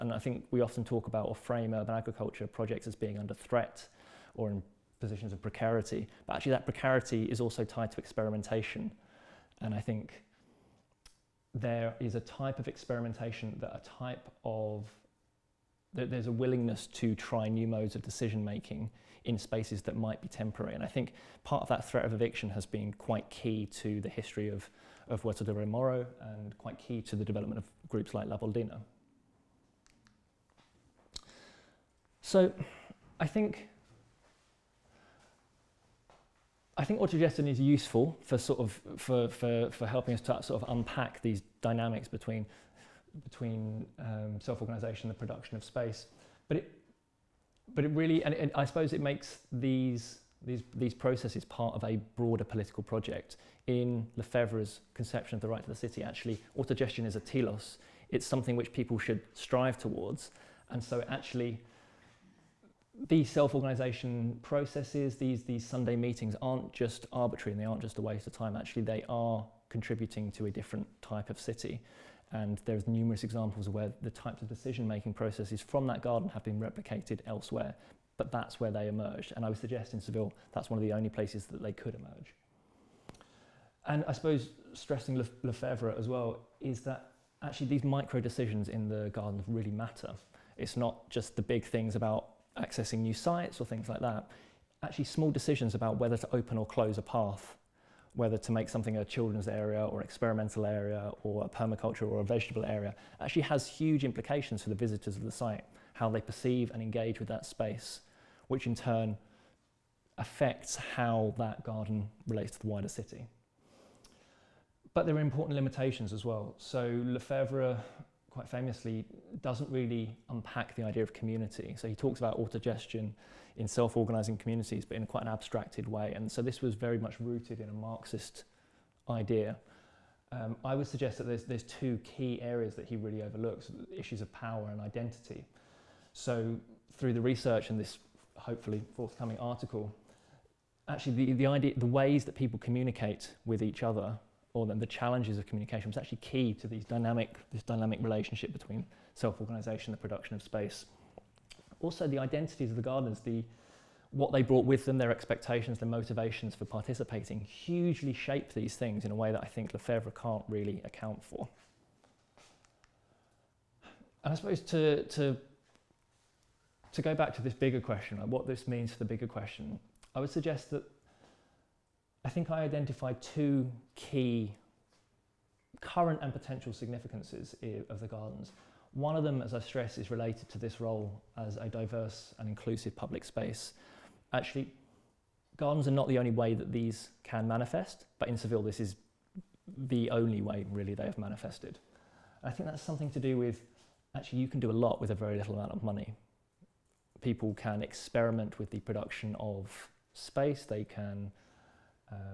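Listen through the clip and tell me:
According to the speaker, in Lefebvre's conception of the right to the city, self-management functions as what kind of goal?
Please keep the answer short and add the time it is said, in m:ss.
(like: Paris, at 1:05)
a telos, at 0:57.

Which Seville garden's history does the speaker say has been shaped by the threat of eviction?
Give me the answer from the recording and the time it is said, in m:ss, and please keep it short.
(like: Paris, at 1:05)
Huerta de Rey Moro, at 0:25.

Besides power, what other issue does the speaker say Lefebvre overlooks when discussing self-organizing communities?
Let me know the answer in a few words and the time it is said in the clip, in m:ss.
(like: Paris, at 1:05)
identity, at 2:14.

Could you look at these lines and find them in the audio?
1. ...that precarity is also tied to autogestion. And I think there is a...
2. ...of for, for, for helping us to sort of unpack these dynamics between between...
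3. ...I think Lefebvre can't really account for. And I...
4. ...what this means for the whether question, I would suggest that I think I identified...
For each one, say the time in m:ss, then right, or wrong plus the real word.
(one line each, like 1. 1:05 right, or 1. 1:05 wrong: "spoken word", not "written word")
1. 0:06 wrong: "experimentation", not "autogestion"
2. 0:38 right
3. 2:39 right
4. 2:48 wrong: "bigger", not "whether".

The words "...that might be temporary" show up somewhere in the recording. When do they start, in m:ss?
0:19.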